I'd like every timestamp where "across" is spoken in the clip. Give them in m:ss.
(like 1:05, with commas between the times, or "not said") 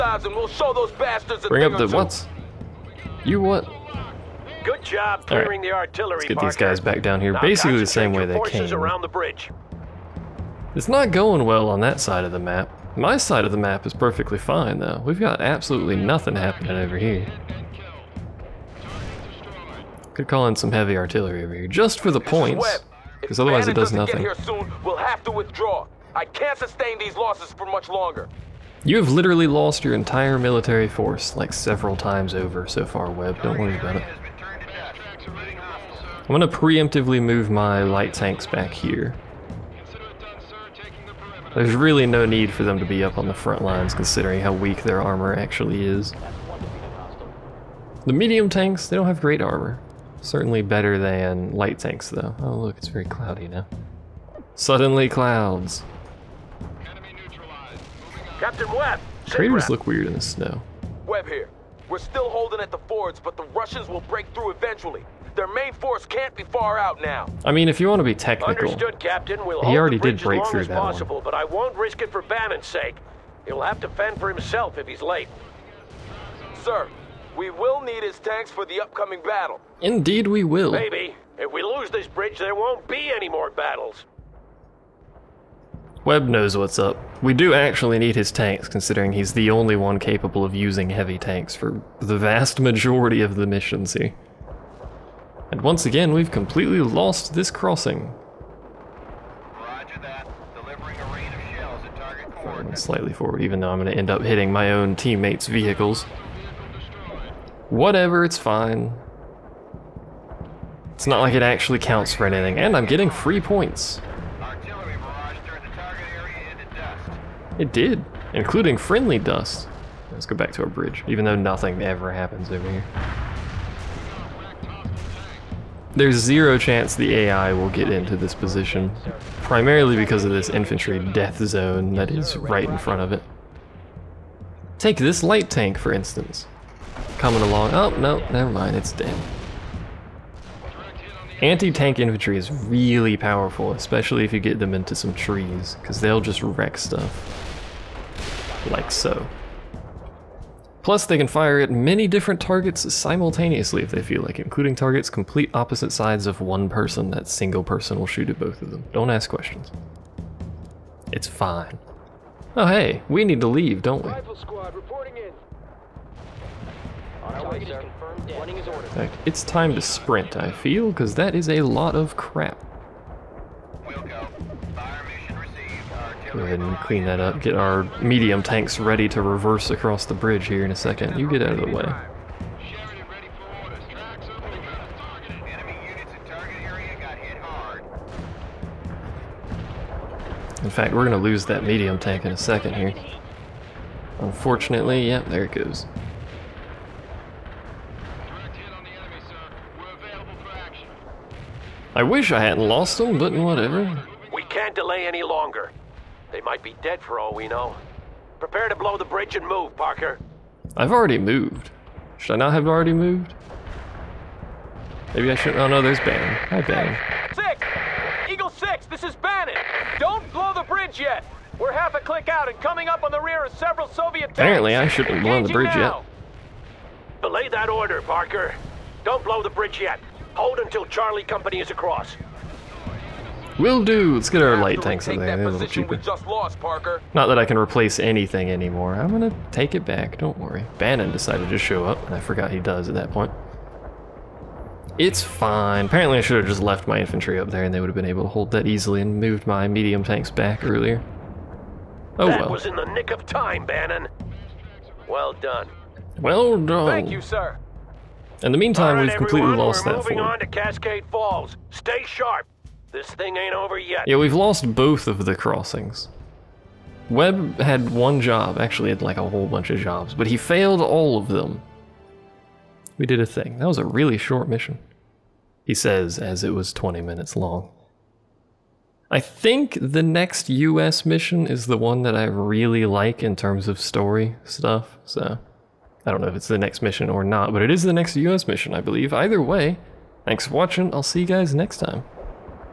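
2:59, 3:51.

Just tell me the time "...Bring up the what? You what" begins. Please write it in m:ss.
0:01.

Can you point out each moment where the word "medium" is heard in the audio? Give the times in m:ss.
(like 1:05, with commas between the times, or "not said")
0:48, 2:58, 3:11, 4:09.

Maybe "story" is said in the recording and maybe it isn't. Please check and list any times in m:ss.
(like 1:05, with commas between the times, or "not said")
4:43.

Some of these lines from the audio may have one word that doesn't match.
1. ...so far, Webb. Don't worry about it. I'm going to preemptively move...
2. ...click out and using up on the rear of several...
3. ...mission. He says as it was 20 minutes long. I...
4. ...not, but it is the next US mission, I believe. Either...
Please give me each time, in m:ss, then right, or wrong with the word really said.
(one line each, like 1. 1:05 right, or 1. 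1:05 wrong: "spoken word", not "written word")
1. 0:32 right
2. 3:41 wrong: "coming", not "using"
3. 4:34 right
4. 4:47 right.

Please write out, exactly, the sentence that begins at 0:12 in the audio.
My side of the map is perfectly fine, though.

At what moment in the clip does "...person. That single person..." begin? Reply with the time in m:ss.
2:36.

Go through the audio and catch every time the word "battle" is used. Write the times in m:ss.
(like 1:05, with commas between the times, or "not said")
1:19, 1:23.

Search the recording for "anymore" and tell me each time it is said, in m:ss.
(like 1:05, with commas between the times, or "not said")
3:58.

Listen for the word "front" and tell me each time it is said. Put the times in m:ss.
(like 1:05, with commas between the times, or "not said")
0:43, 2:12.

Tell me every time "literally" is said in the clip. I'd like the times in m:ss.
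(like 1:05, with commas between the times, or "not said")
0:29.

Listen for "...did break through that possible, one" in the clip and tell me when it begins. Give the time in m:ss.
1:09.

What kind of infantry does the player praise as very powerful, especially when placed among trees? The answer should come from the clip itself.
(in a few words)
Anti-tank infantry.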